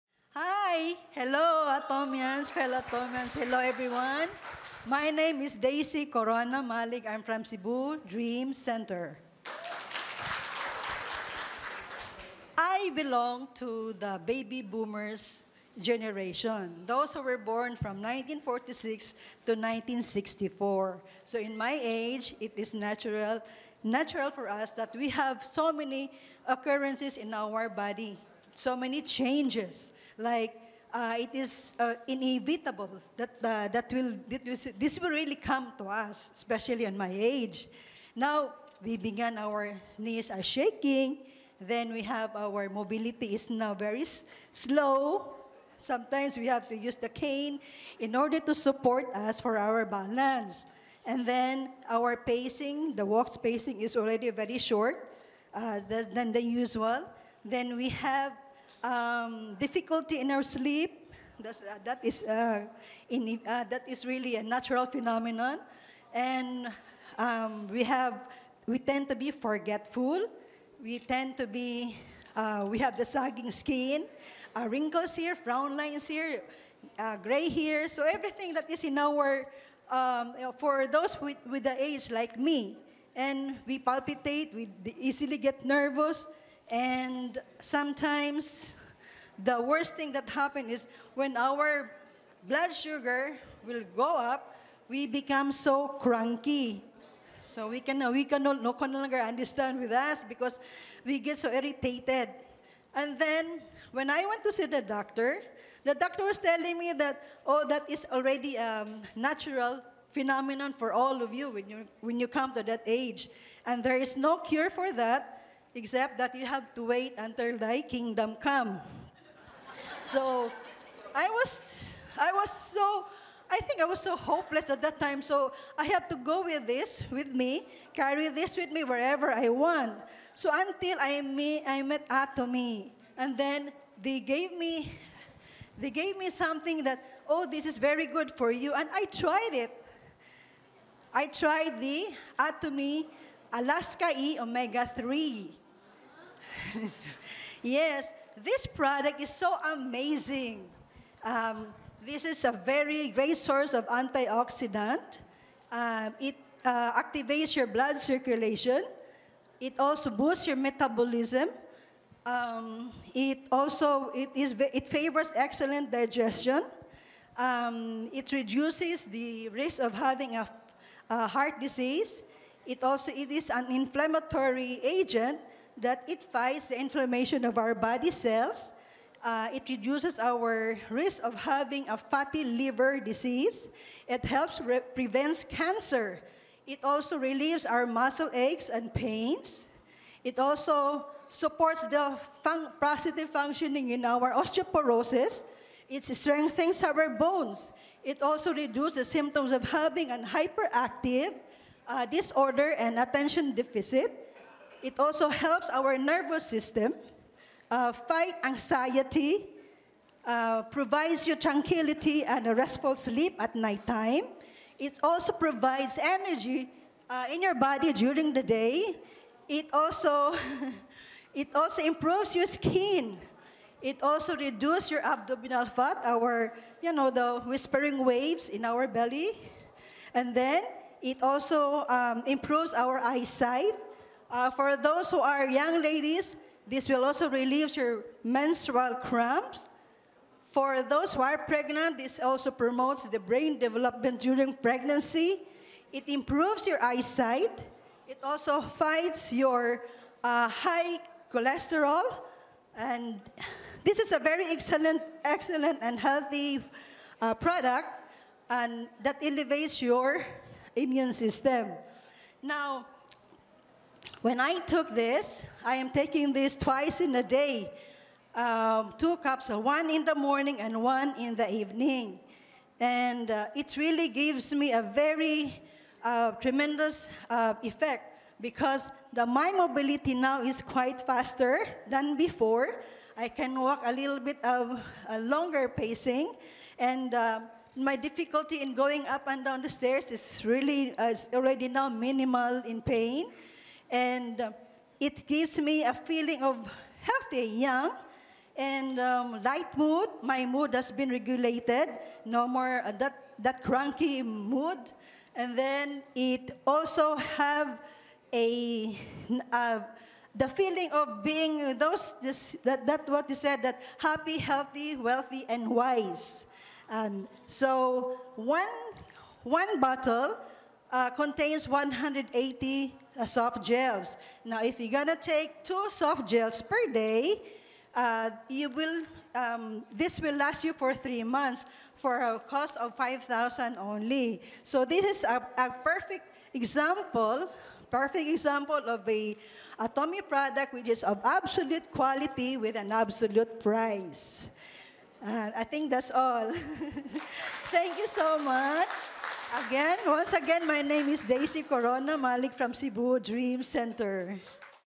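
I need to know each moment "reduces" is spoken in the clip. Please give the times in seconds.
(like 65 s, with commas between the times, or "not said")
168 s, 179 s, 198 s, 224 s.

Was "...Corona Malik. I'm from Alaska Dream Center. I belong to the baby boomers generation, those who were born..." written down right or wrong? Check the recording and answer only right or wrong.
wrong.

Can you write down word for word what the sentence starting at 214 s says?
It also provides energy uh, in your body during the day.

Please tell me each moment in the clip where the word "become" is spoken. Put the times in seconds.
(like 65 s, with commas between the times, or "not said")
95 s.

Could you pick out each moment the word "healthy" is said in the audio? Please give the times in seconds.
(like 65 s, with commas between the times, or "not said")
255 s, 297 s, 314 s.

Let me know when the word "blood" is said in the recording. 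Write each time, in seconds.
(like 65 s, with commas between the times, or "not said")
92 s, 157 s.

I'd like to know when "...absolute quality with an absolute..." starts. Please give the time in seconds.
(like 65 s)
341 s.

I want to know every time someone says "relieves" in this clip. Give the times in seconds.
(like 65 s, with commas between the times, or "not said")
187 s, 237 s.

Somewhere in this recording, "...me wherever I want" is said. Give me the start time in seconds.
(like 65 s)
128 s.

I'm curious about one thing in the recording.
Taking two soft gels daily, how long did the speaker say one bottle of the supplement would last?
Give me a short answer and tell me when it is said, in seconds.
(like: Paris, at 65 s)
three months, at 330 s.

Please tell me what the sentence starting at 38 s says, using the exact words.
Now, we began our knees are shaking.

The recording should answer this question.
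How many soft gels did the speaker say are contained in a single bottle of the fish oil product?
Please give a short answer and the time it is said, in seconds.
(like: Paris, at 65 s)
180, at 321 s.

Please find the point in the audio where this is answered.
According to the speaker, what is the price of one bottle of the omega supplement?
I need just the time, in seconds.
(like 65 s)
332 s.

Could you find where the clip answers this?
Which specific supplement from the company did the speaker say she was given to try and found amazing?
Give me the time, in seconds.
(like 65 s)
142 s.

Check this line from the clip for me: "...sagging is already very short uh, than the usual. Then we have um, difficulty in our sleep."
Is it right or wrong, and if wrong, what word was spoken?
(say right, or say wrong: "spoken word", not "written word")
wrong: "spacing", not "sagging".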